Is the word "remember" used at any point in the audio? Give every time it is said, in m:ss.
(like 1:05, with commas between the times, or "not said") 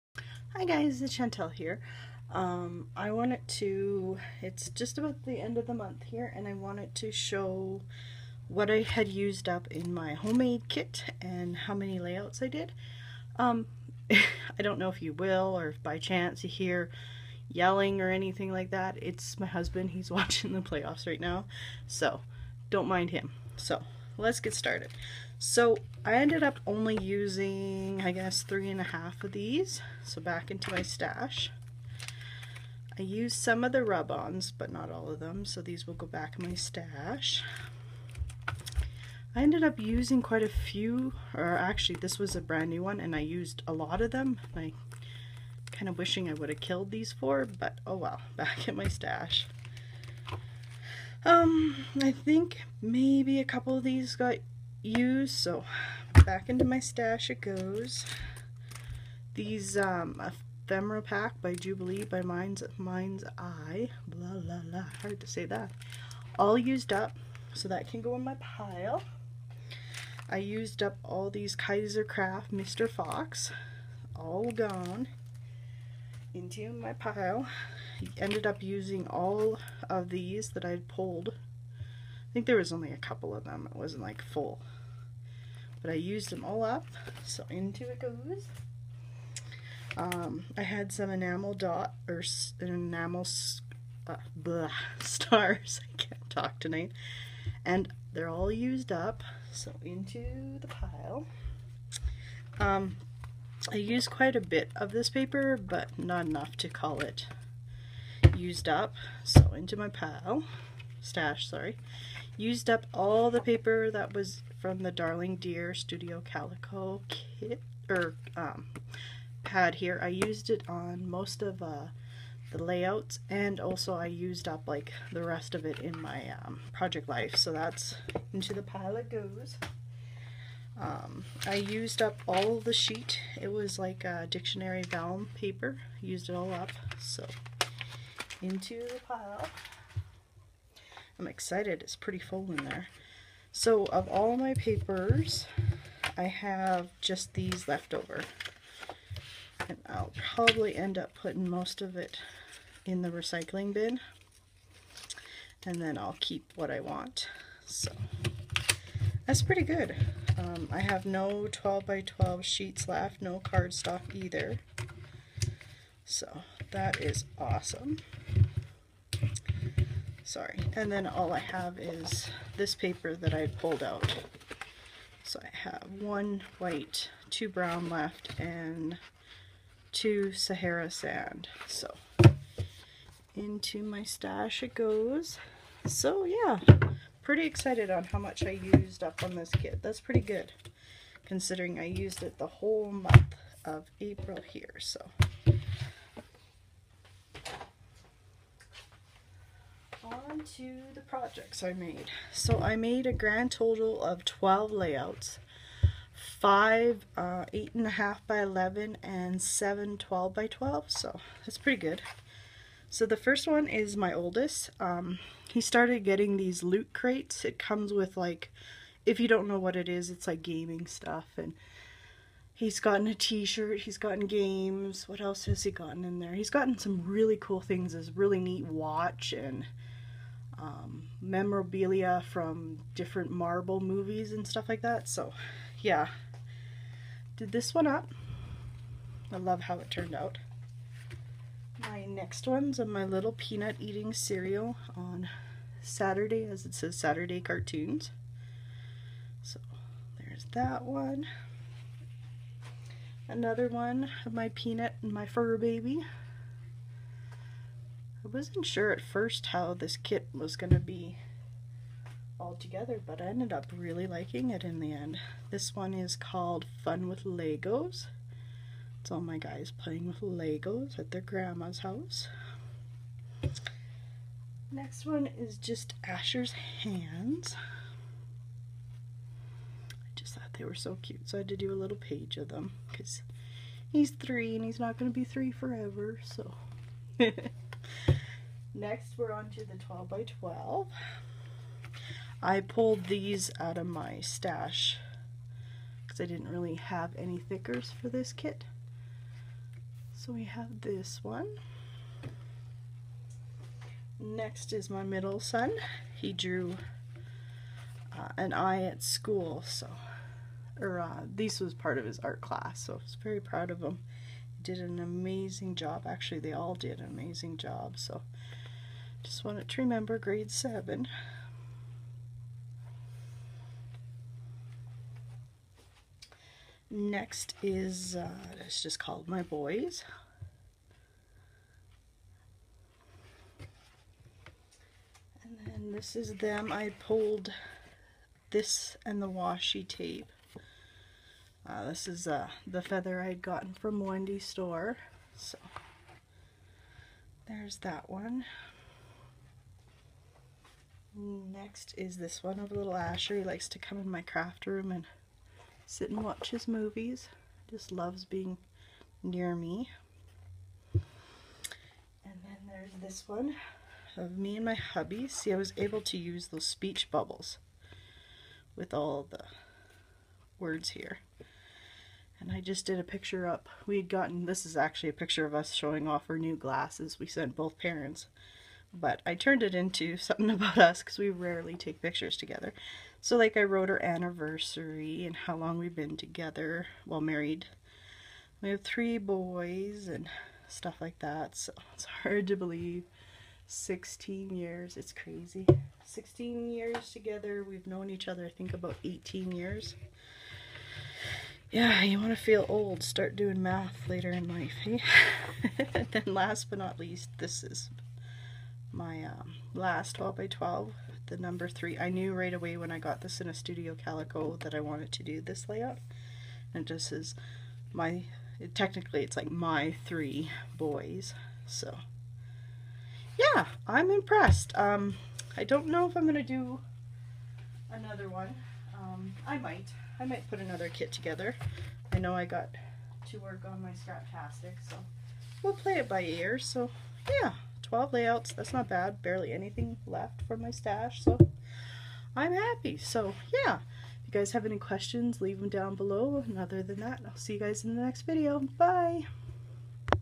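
5:19.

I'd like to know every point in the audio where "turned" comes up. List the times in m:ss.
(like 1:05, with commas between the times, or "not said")
3:59, 6:19.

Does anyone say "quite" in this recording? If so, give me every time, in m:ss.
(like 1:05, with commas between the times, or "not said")
0:40, 1:44.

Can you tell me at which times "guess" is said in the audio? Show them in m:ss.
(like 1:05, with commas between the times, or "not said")
0:28.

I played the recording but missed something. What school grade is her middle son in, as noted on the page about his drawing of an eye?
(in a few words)
grade 7.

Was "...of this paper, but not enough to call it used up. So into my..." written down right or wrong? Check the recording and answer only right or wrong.
right.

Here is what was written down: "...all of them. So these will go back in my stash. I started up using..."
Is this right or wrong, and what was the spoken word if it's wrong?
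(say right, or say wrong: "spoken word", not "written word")
wrong: "ended", not "started".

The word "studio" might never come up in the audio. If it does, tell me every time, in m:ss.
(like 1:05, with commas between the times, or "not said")
1:55, 6:53.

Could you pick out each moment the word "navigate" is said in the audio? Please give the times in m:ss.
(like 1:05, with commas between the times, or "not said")
not said.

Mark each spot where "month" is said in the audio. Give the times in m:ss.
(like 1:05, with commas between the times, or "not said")
0:05, 3:12.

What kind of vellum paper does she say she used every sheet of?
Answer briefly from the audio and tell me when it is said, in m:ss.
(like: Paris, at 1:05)
dictionary vellum, at 2:14.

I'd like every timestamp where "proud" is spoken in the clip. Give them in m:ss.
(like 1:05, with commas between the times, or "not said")
5:13.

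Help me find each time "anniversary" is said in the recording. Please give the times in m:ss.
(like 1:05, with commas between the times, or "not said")
6:24.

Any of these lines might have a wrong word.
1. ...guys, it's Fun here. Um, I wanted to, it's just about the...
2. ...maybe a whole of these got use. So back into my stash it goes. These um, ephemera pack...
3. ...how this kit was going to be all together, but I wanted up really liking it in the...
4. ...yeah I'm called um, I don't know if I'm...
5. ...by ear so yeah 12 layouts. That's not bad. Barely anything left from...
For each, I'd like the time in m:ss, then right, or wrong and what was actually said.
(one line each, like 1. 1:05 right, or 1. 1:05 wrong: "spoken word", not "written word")
1. 0:00 wrong: "Shantele", not "Fun"
2. 0:52 wrong: "couple", not "whole"
3. 4:19 wrong: "ended", not "wanted"
4. 7:03 wrong: "impressed", not "called"
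5. 7:16 right.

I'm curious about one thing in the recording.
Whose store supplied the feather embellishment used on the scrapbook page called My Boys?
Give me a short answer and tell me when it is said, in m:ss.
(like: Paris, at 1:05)
Wendy's, at 5:44.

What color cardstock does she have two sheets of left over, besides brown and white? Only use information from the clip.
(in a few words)
Sahara sand.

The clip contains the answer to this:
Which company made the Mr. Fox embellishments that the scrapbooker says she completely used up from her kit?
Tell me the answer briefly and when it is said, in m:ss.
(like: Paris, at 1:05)
Kaiser Craft, at 1:11.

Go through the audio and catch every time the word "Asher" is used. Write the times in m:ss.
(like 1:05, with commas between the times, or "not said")
4:36, 5:52.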